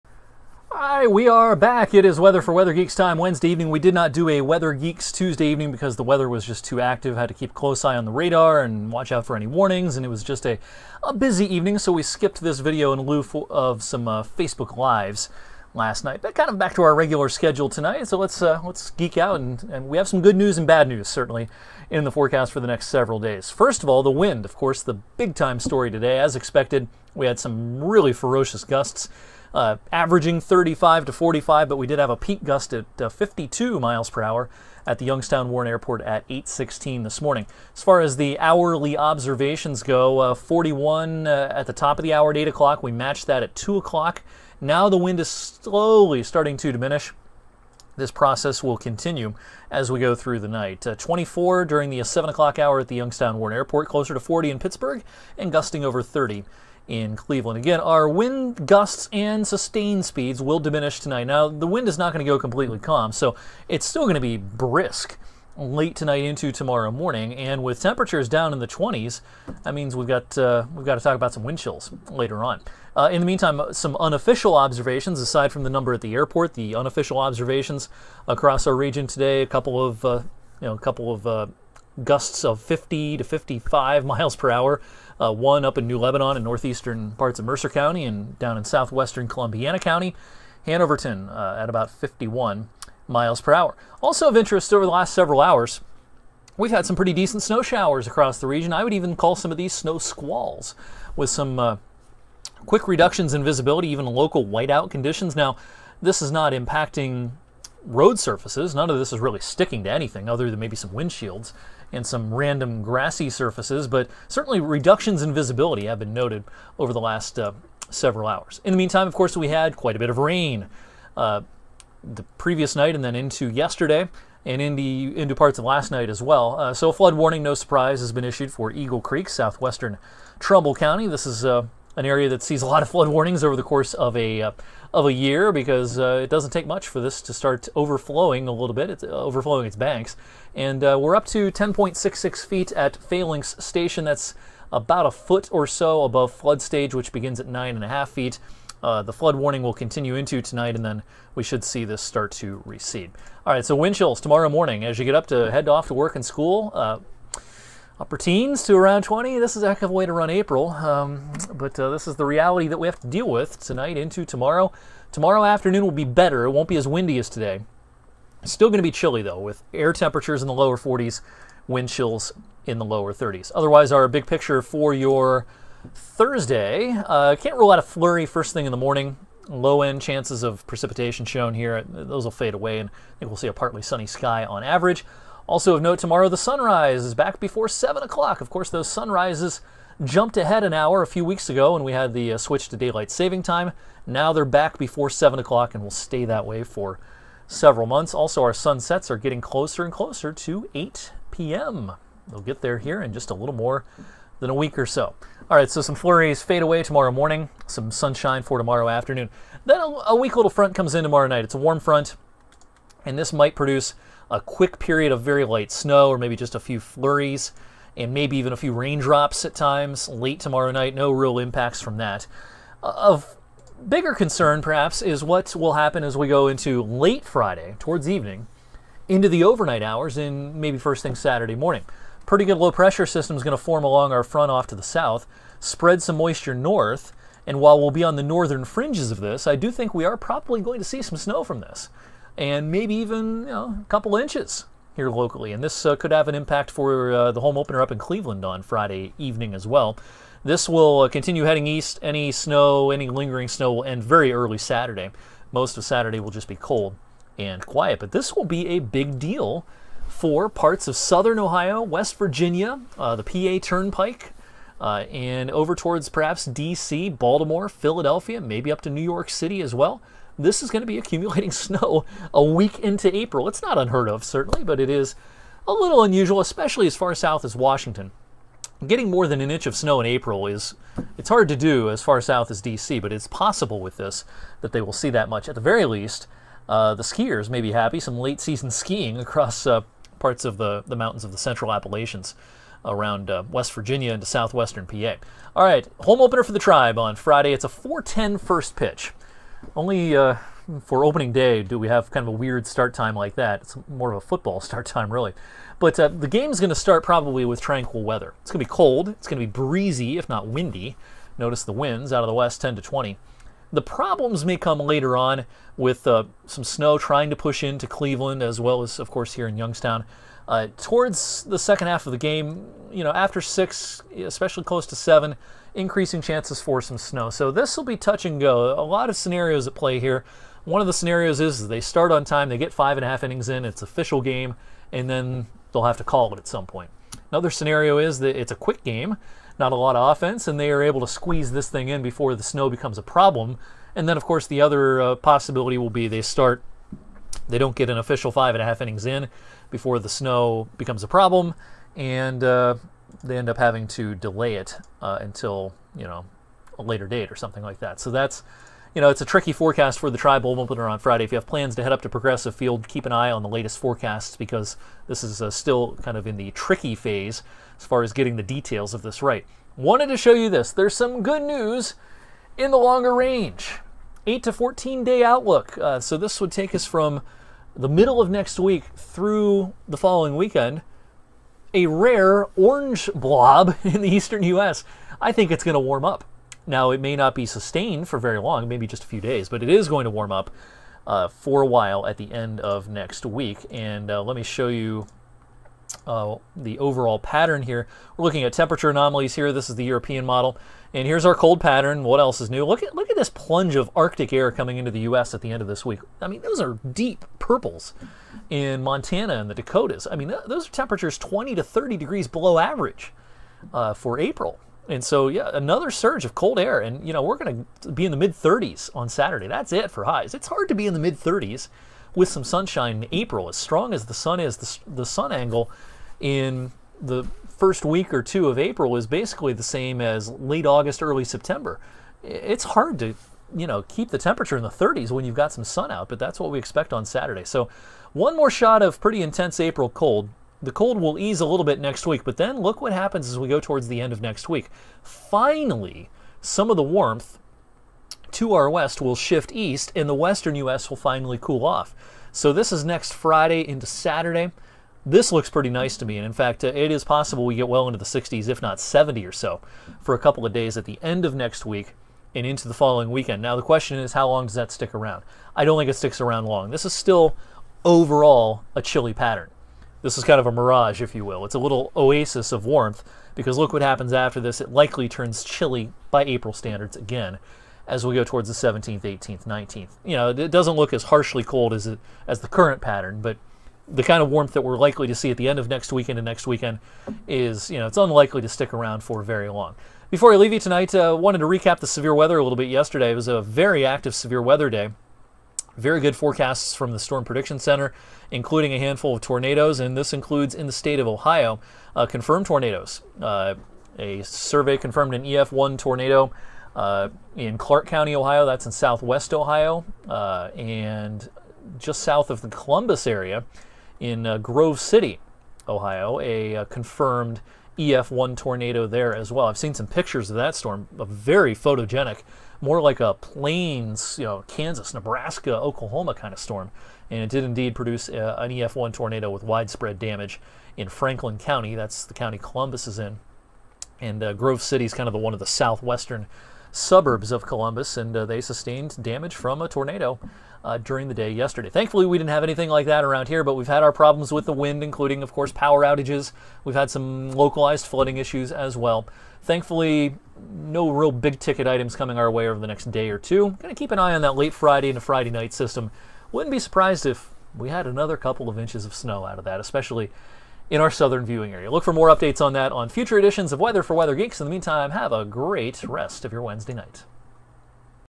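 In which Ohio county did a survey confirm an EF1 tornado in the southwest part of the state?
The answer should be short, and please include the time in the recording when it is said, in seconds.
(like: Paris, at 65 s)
Clark County, at 507 s.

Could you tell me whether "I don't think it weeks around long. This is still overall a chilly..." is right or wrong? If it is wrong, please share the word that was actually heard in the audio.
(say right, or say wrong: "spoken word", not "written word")
wrong: "sticks", not "weeks".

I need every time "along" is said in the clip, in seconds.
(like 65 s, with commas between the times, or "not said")
233 s.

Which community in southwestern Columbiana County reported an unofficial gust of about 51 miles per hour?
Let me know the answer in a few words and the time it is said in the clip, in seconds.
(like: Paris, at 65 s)
Hanoverton, at 90 s.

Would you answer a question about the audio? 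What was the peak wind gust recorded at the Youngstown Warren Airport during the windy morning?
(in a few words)
52 miles per hour.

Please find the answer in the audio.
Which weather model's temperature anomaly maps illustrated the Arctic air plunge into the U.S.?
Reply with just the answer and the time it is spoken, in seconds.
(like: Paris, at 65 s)
European model, at 399 s.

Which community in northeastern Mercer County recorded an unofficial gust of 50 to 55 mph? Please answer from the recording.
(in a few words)
New Lebanon.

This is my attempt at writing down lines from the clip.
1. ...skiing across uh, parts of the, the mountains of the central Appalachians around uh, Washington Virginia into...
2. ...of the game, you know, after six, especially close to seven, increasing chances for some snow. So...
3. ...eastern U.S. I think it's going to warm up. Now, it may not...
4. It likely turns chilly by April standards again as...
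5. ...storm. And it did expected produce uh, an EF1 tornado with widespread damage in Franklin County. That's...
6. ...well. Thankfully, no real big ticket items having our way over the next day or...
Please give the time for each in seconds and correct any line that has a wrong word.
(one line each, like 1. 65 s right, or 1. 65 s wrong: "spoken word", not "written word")
1. 288 s wrong: "West", not "Washington"
2. 322 s right
3. 384 s right
4. 474 s right
5. 526 s wrong: "indeed", not "expected"
6. 548 s wrong: "coming", not "having".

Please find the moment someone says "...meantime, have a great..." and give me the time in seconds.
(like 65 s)
564 s.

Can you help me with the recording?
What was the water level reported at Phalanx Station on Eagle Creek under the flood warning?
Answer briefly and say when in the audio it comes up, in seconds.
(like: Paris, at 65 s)
10.66 feet, at 141 s.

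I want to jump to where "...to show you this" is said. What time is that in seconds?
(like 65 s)
370 s.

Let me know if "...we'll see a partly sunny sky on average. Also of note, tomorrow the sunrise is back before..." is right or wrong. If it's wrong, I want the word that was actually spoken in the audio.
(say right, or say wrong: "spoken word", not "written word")
right.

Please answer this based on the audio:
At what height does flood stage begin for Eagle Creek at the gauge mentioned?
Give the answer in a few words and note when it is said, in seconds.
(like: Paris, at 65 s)
9.5 feet, at 147 s.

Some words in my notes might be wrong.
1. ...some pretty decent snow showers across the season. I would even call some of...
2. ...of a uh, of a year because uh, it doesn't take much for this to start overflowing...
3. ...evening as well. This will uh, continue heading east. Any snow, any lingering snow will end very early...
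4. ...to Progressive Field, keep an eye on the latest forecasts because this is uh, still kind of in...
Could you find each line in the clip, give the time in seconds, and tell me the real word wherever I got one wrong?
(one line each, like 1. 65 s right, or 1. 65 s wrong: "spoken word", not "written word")
1. 96 s wrong: "region", not "season"
2. 133 s right
3. 249 s right
4. 362 s right.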